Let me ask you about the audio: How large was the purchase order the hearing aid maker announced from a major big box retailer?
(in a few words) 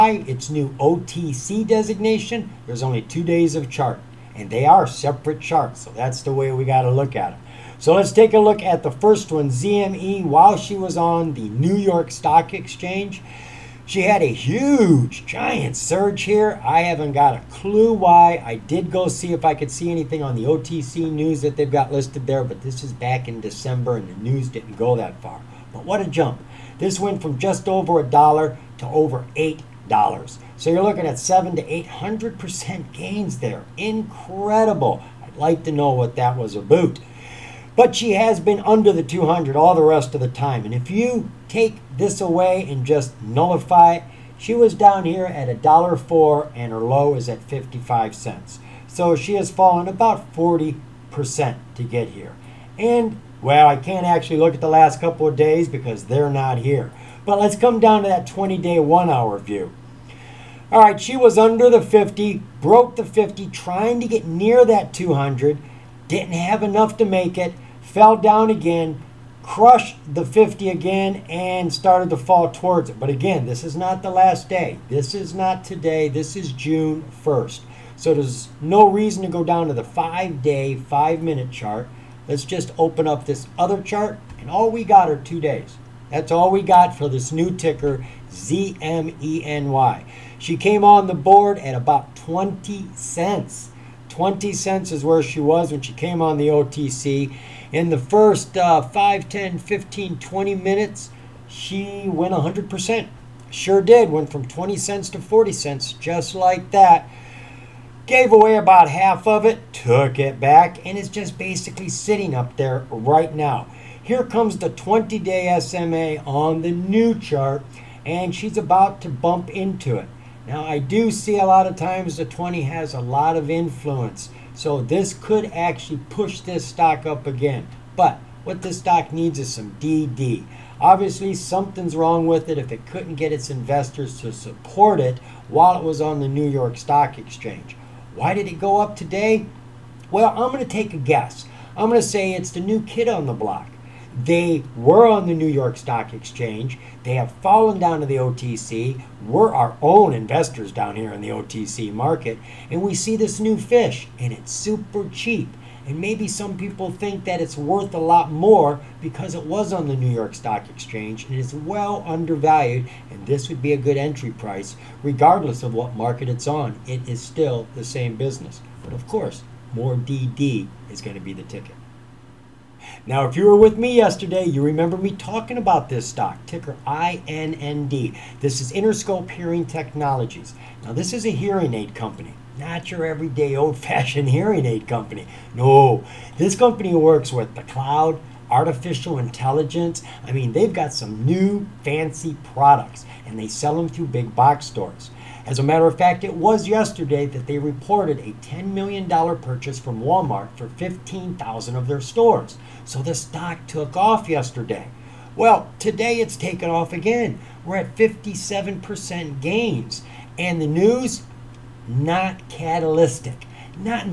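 $10 million.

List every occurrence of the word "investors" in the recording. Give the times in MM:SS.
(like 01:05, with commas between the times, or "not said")
02:13, 02:30.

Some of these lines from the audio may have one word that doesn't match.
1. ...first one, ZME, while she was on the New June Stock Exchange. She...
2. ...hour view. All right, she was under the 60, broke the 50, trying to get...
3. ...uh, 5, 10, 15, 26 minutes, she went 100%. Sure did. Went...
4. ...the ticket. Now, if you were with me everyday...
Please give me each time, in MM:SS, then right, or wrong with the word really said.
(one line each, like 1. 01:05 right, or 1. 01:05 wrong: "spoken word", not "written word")
1. 00:08 wrong: "York", not "June"
2. 00:59 wrong: "50", not "60"
3. 01:38 wrong: "20", not "26"
4. 02:51 wrong: "yesterday", not "everyday".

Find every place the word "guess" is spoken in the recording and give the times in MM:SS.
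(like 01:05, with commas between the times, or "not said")
02:20.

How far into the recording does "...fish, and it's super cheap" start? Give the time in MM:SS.
02:33.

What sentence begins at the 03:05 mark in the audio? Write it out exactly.
No, this company works with the cloud, artificial intelligence.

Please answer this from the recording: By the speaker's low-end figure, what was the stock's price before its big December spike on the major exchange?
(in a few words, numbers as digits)
$1.04.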